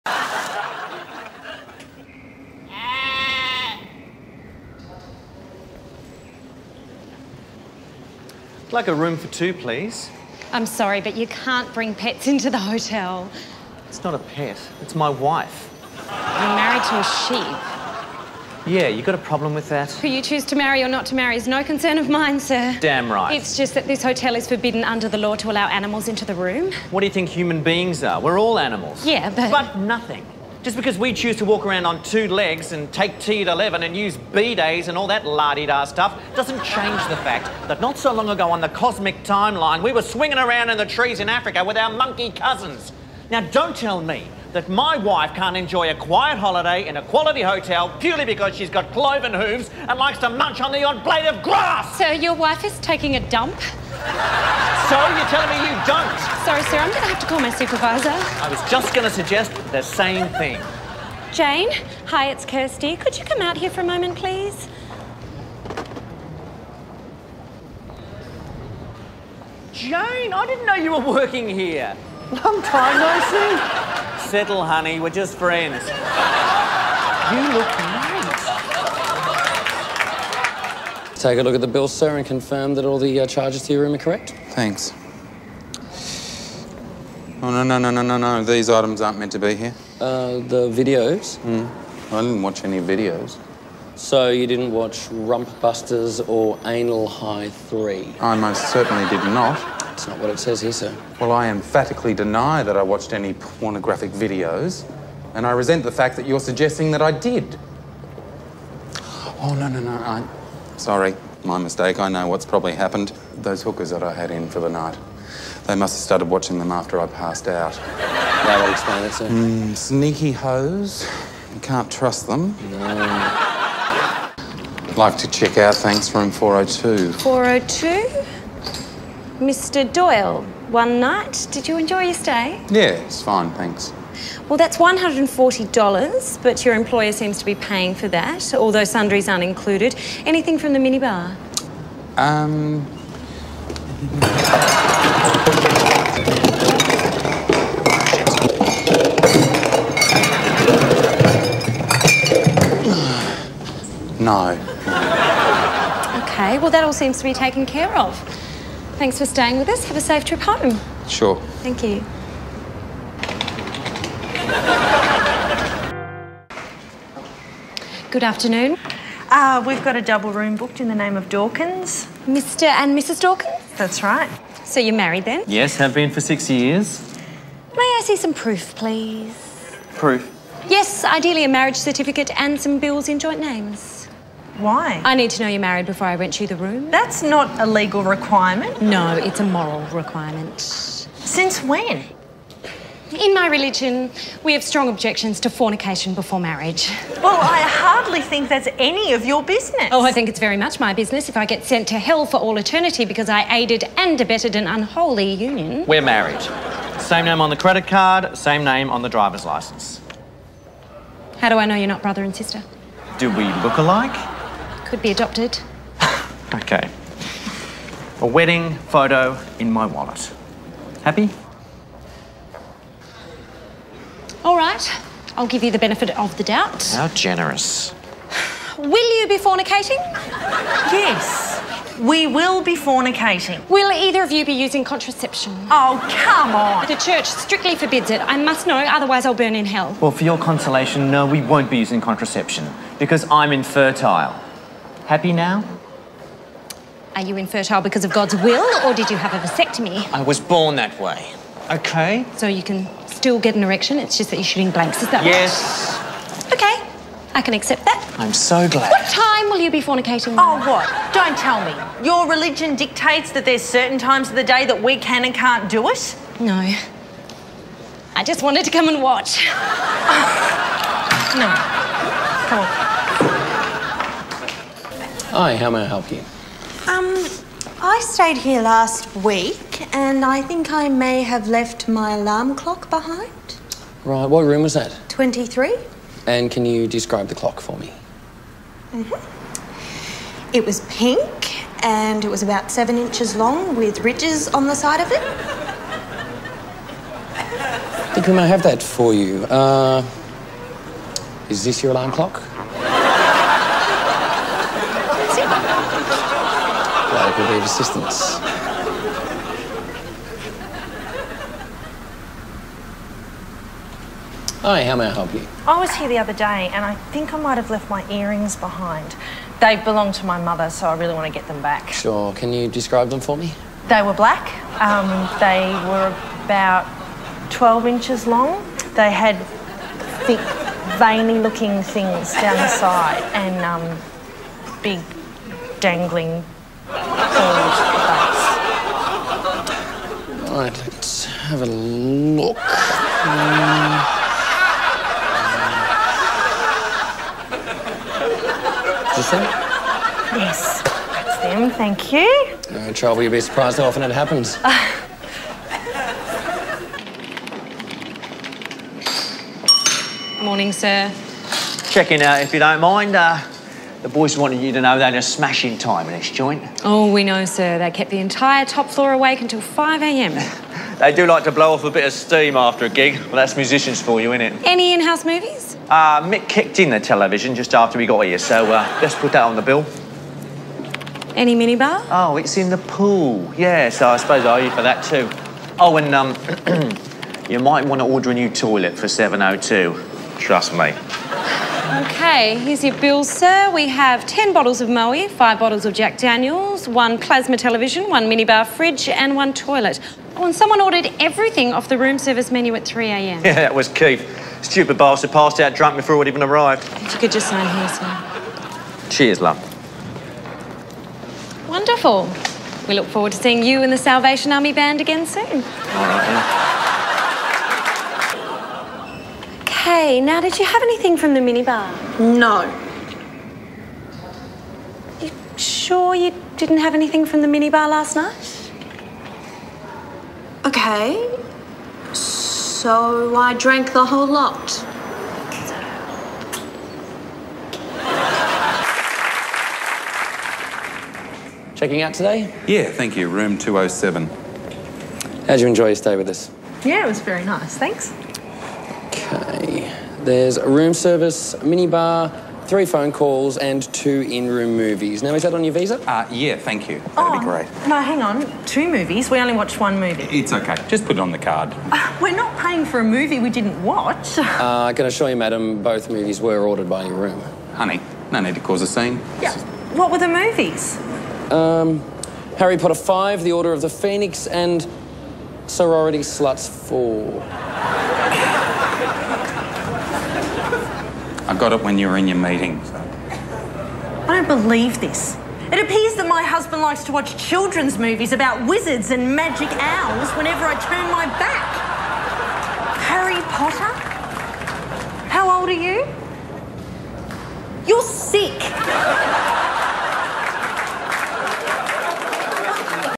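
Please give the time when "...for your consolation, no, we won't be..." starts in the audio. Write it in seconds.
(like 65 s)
240 s.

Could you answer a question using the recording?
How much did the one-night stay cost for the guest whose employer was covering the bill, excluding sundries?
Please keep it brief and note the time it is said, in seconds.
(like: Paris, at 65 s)
$140, at 134 s.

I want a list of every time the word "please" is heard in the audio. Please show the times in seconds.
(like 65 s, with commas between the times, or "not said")
9 s, 64 s, 178 s.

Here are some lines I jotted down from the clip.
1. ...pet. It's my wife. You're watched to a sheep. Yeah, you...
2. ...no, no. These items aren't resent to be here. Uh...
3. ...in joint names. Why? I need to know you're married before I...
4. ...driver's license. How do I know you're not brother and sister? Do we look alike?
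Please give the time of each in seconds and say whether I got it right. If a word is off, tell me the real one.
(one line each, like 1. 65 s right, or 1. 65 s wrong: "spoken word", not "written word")
1. 14 s wrong: "married", not "watched"
2. 88 s wrong: "meant", not "resent"
3. 183 s right
4. 209 s right.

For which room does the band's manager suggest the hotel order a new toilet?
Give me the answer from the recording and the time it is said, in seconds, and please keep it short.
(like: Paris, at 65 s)
702, at 389 s.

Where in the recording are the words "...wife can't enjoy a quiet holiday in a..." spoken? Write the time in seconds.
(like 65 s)
44 s.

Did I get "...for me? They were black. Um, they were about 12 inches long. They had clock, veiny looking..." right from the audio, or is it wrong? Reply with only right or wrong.
wrong.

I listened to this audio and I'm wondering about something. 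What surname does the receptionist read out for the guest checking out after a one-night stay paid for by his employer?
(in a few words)
Doyle.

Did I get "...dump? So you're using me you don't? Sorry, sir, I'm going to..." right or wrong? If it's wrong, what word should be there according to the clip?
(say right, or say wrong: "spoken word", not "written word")
wrong: "telling", not "using".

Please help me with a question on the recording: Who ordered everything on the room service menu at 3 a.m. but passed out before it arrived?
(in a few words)
Keith.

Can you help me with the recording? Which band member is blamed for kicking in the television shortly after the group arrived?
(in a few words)
Mick.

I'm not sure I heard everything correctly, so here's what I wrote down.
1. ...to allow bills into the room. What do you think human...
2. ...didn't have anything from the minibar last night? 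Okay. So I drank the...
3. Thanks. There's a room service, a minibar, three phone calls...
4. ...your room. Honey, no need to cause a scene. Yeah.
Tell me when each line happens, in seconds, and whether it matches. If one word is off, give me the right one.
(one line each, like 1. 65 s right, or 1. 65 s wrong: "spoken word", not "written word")
1. 25 s wrong: "animals", not "bills"
2. 426 s right
3. 447 s right
4. 467 s right.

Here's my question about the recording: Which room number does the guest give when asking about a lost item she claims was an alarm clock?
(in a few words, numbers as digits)
23.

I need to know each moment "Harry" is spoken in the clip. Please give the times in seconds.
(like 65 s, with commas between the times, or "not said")
472 s, 493 s.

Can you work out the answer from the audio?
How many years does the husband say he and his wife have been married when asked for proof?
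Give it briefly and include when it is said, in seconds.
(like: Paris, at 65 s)
6, at 176 s.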